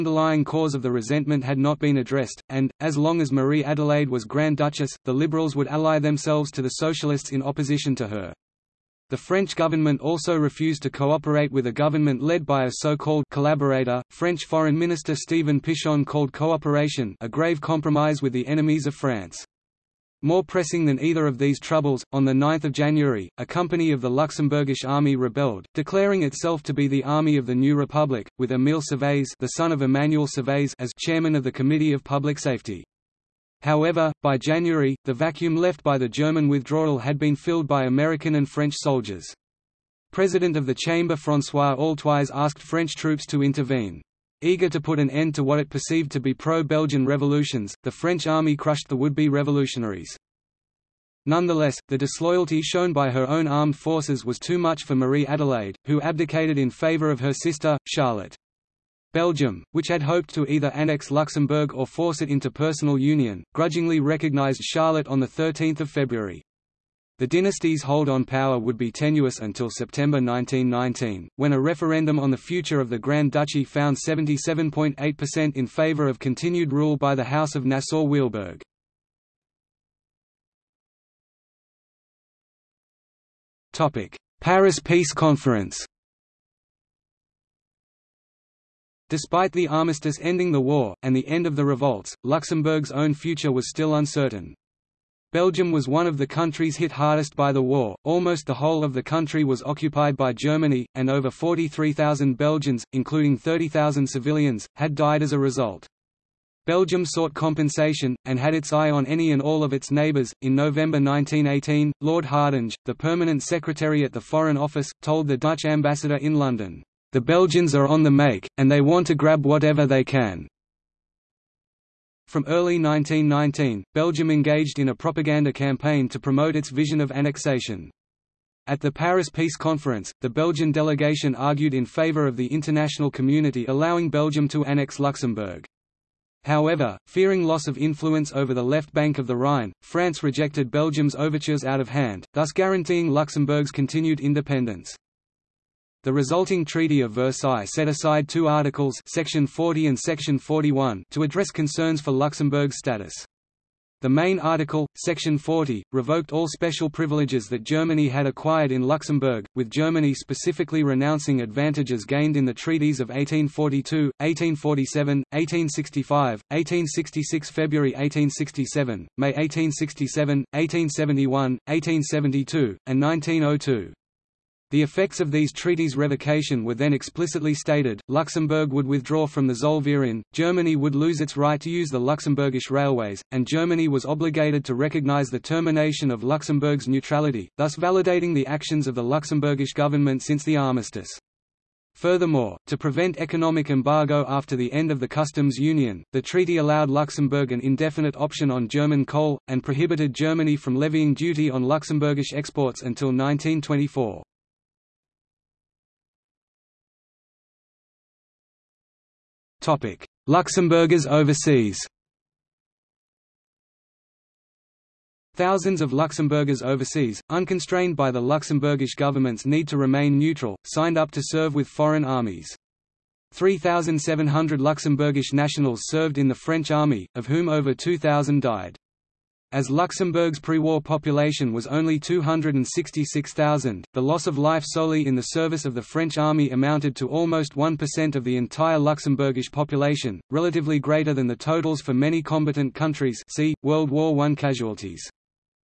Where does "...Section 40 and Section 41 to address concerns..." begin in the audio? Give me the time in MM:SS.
02:29.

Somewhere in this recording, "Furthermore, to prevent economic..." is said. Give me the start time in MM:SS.
03:11.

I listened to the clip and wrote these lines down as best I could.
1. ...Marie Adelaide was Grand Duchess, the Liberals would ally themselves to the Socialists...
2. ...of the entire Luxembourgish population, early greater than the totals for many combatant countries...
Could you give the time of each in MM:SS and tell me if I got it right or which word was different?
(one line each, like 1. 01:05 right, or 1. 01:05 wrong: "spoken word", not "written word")
1. 00:03 right
2. 03:58 wrong: "relatively", not "early".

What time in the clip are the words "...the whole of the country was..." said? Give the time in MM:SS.
01:38.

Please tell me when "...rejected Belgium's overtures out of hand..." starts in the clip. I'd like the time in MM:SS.
02:20.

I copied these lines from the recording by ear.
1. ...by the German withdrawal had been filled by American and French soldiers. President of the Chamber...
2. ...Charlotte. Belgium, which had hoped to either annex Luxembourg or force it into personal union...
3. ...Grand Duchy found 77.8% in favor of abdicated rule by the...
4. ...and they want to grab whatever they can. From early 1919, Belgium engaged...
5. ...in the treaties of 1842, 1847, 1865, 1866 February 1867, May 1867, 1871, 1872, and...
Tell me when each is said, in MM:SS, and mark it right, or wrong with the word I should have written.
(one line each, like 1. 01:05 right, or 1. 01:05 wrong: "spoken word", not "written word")
1. 00:35 right
2. 00:57 right
3. 01:12 wrong: "continued", not "abdicated"
4. 01:58 right
5. 02:42 right.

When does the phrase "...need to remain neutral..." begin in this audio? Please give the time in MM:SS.
03:39.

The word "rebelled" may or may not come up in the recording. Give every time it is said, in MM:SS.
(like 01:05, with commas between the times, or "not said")
00:25.